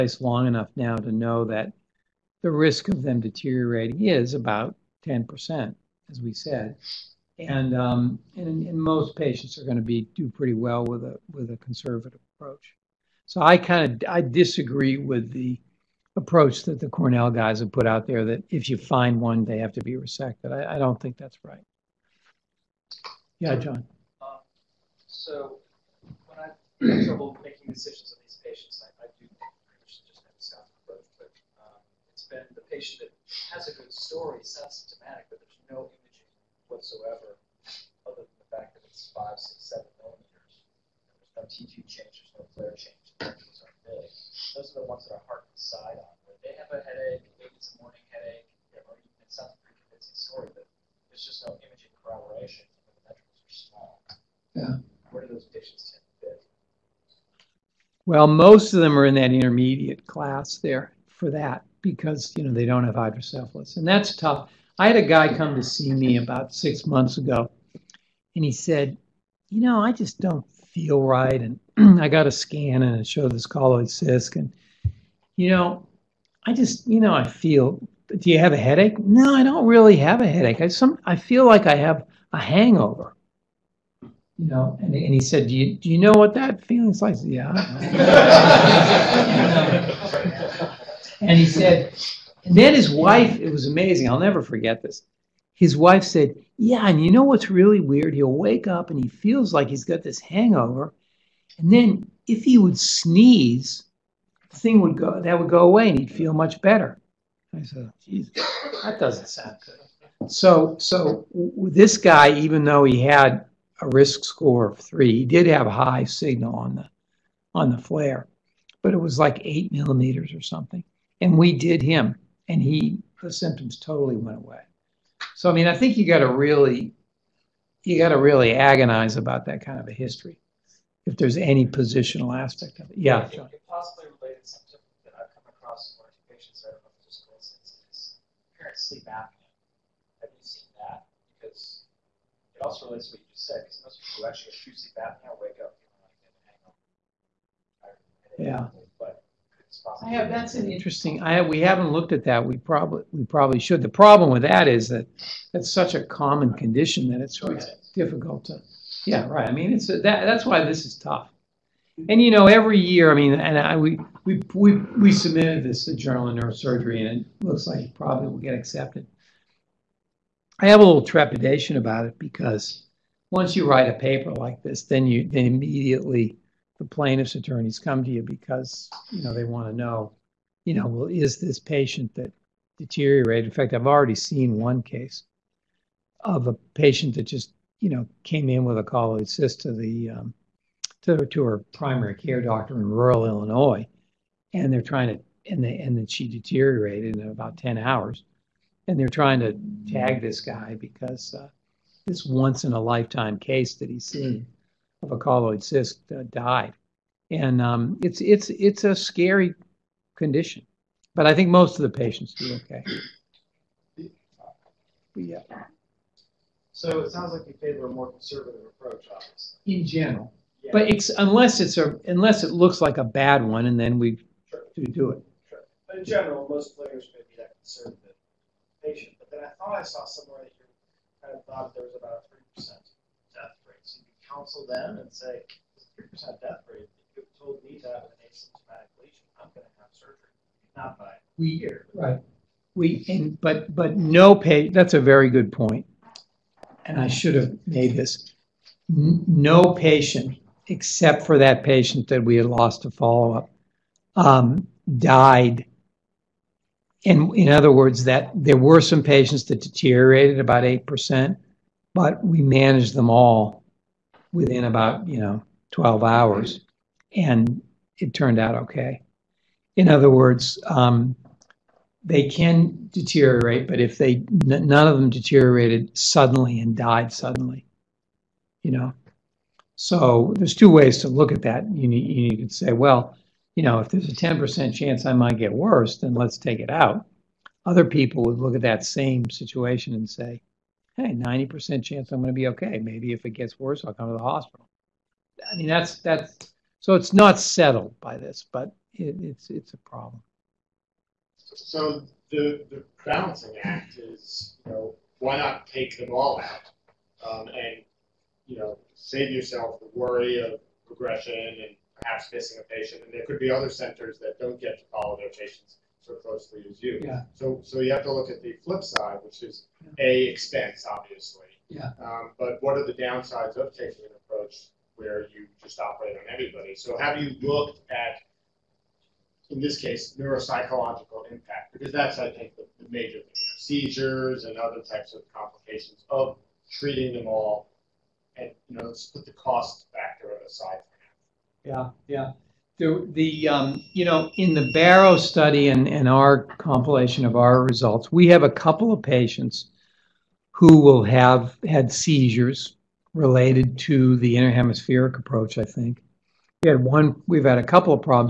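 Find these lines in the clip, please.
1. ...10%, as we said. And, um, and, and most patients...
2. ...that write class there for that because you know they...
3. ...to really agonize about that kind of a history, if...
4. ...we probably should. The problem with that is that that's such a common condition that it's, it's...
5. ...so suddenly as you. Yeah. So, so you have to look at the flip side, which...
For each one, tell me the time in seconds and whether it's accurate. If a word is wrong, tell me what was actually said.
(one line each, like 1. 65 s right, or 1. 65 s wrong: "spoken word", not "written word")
1. 5 s right
2. 59 s wrong: "intermediate", not "write"
3. 128 s right
4. 153 s right
5. 316 s wrong: "closely", not "suddenly".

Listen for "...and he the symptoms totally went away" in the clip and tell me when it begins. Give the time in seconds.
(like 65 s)
122 s.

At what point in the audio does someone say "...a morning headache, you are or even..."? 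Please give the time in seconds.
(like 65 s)
47 s.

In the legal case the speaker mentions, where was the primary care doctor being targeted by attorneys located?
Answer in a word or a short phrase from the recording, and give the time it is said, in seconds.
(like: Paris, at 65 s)
rural Illinois, at 192 s.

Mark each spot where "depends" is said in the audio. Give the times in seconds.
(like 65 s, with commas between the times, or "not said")
not said.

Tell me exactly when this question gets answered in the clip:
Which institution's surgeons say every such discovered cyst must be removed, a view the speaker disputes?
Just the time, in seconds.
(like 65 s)
16 s.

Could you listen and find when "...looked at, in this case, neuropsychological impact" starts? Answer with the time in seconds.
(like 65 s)
327 s.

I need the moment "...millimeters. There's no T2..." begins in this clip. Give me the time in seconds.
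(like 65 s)
40 s.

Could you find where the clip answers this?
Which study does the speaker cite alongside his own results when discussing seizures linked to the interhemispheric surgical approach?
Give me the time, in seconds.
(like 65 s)
344 s.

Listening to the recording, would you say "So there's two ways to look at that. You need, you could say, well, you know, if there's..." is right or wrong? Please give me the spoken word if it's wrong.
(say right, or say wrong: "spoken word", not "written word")
right.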